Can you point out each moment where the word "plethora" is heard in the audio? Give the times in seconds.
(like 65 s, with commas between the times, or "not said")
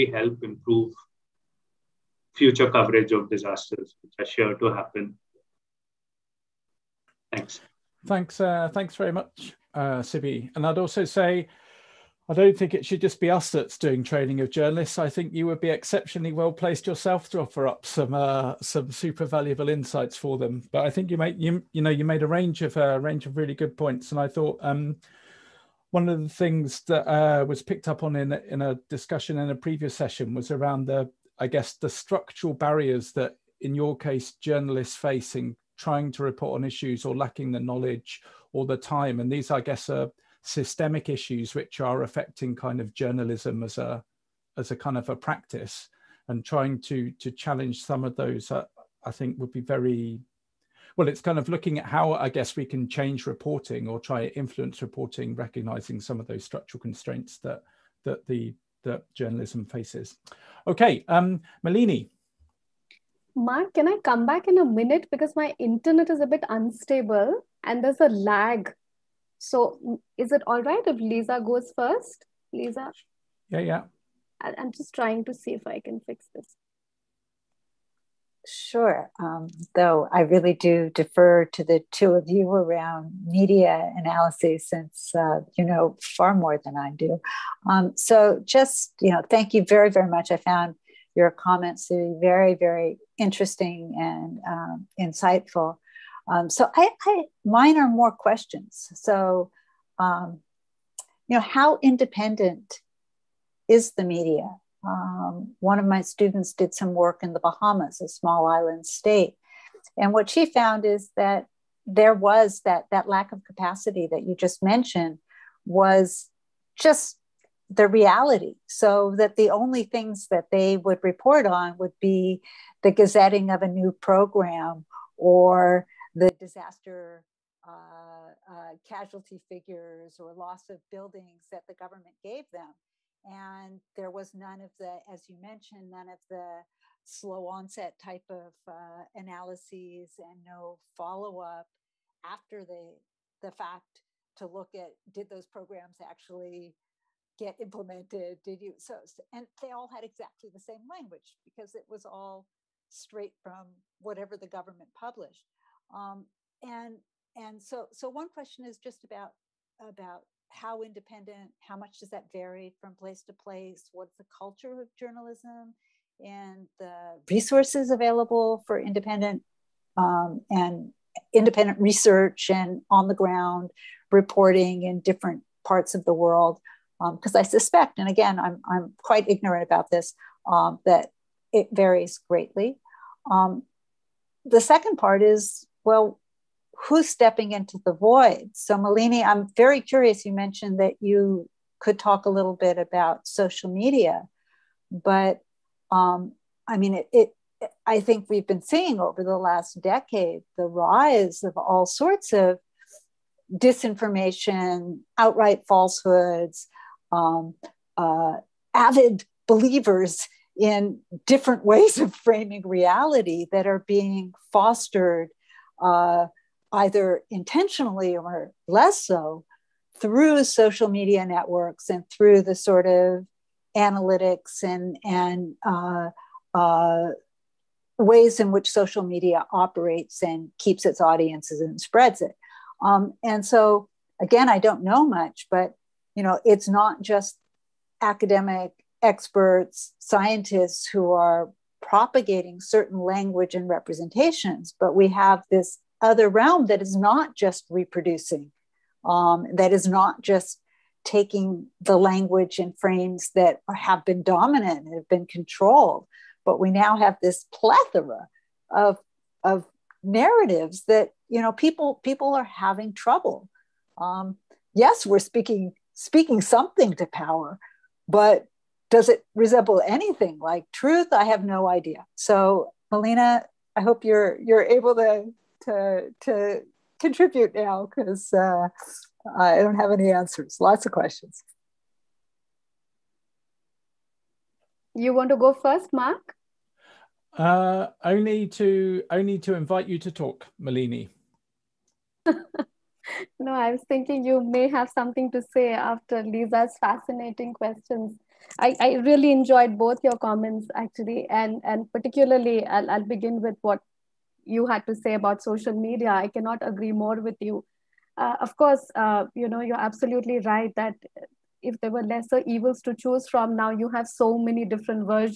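257 s.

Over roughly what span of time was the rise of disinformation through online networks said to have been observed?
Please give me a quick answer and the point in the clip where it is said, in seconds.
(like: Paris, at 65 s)
The last decade, at 199 s.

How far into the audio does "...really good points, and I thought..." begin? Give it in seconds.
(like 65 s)
23 s.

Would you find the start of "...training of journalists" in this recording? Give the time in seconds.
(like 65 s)
14 s.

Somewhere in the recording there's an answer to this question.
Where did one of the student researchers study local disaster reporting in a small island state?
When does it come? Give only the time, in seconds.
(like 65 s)
107 s.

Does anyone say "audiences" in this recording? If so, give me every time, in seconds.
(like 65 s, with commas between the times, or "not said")
231 s.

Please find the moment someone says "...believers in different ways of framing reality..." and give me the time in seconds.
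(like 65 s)
209 s.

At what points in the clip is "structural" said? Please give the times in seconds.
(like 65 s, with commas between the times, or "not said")
31 s, 56 s.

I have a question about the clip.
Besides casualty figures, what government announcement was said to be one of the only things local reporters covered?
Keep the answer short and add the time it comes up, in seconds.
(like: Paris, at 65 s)
The gazetting of a new program, at 122 s.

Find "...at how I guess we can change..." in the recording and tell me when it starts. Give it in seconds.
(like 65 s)
51 s.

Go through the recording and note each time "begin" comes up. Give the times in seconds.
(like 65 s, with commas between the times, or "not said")
303 s.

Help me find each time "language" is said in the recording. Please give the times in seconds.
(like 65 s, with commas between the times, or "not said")
150 s, 242 s, 251 s.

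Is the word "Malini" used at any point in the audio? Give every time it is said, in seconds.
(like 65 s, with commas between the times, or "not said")
61 s, 188 s, 272 s, 290 s.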